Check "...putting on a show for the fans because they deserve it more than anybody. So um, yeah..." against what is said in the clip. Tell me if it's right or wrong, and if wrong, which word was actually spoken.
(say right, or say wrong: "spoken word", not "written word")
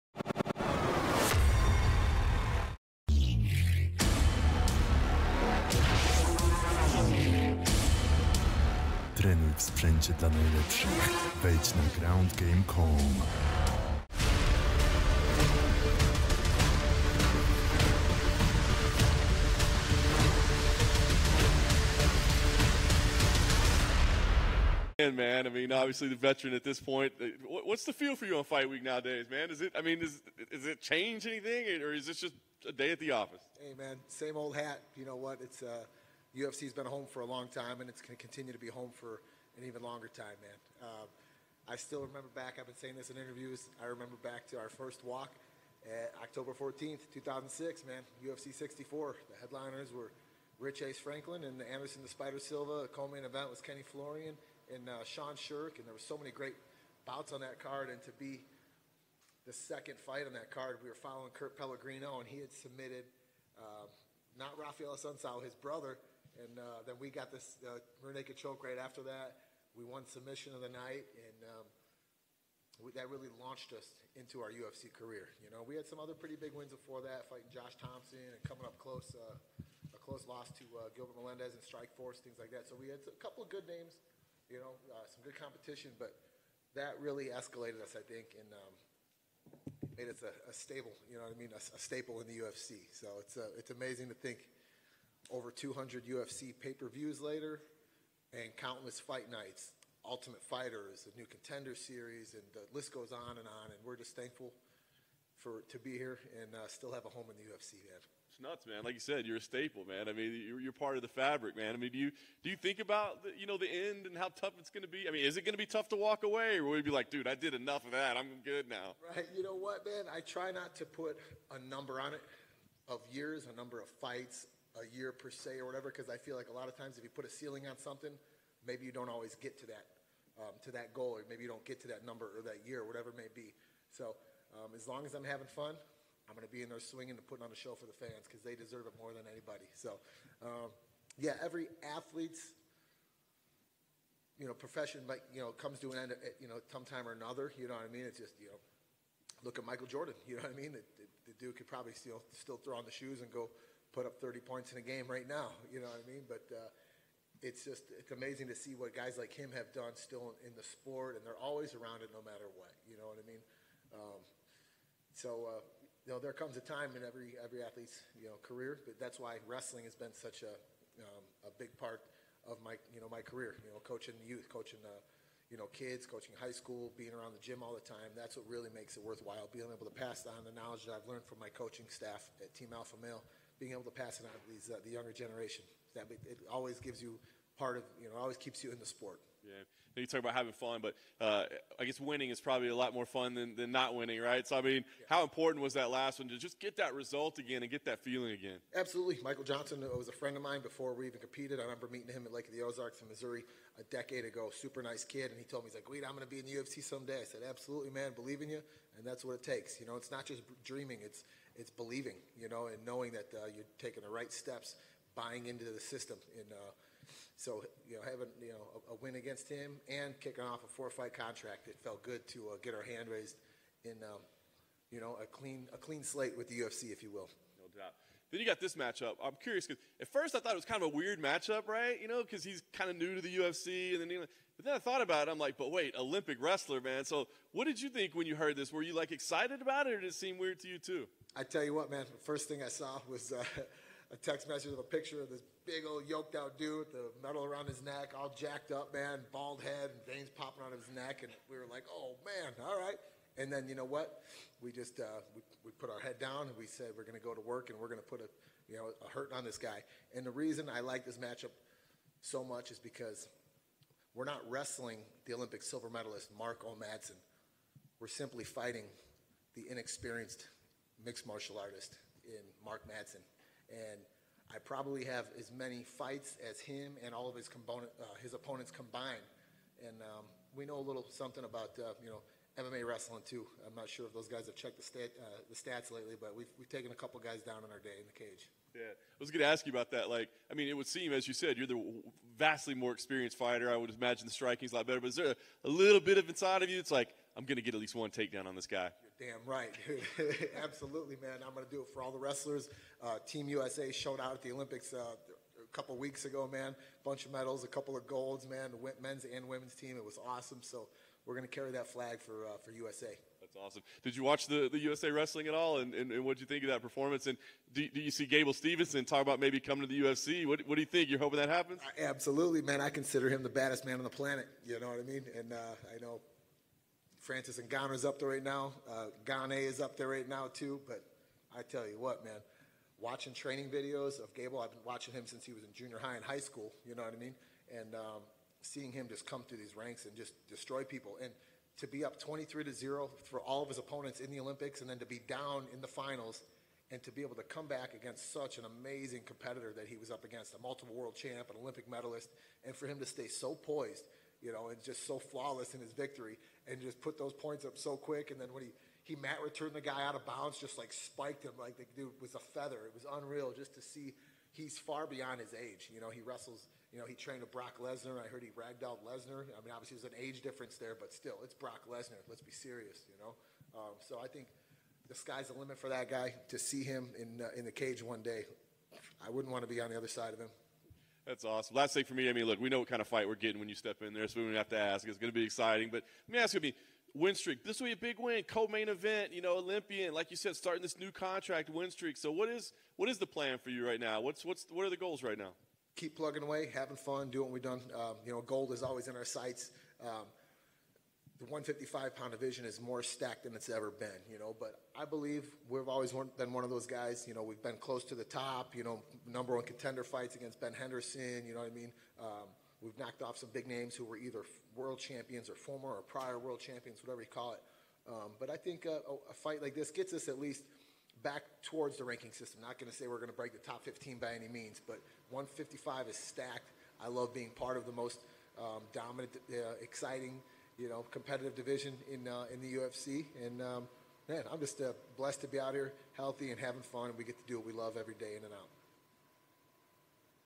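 right.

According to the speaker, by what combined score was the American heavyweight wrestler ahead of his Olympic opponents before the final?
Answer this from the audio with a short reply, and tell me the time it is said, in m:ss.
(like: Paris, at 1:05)
23 to 0, at 5:42.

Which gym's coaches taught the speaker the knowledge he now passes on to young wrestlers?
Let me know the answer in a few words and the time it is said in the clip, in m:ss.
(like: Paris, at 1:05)
Team Alpha Male, at 3:02.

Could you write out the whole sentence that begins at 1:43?
And we're just thankful for to be here and uh, still have a home in the UFC, man.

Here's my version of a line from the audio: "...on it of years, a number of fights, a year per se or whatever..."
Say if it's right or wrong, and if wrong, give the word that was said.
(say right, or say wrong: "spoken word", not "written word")
right.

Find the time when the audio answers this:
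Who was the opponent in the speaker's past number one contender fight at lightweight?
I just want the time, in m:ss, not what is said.
6:50.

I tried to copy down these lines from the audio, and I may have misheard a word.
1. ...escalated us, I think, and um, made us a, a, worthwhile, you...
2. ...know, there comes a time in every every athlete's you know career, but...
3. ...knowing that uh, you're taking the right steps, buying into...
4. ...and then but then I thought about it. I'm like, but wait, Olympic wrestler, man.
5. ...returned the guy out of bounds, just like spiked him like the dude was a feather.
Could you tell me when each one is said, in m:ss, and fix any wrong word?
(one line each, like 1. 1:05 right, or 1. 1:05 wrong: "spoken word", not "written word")
1. 1:27 wrong: "stable", not "worthwhile"
2. 2:46 right
3. 3:32 right
4. 3:53 right
5. 5:59 right.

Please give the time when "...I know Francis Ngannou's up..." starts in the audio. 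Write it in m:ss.
5:25.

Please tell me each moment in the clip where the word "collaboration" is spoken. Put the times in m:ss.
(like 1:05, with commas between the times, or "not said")
not said.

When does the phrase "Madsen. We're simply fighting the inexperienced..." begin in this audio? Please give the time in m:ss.
4:26.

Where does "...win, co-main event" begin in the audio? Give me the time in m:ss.
6:28.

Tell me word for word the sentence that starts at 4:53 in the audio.
I would imagine the striking's a lot better.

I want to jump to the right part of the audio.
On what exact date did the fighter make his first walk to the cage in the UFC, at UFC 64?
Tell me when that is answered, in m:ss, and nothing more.
0:46.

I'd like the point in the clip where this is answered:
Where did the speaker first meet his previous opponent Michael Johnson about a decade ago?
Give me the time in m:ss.
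3:22.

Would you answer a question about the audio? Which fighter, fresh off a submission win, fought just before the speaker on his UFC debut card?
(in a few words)
Kurt Pellegrino.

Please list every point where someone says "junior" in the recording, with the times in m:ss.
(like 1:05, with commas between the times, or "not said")
5:35.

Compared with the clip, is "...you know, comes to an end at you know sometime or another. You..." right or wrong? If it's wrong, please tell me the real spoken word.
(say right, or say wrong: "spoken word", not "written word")
right.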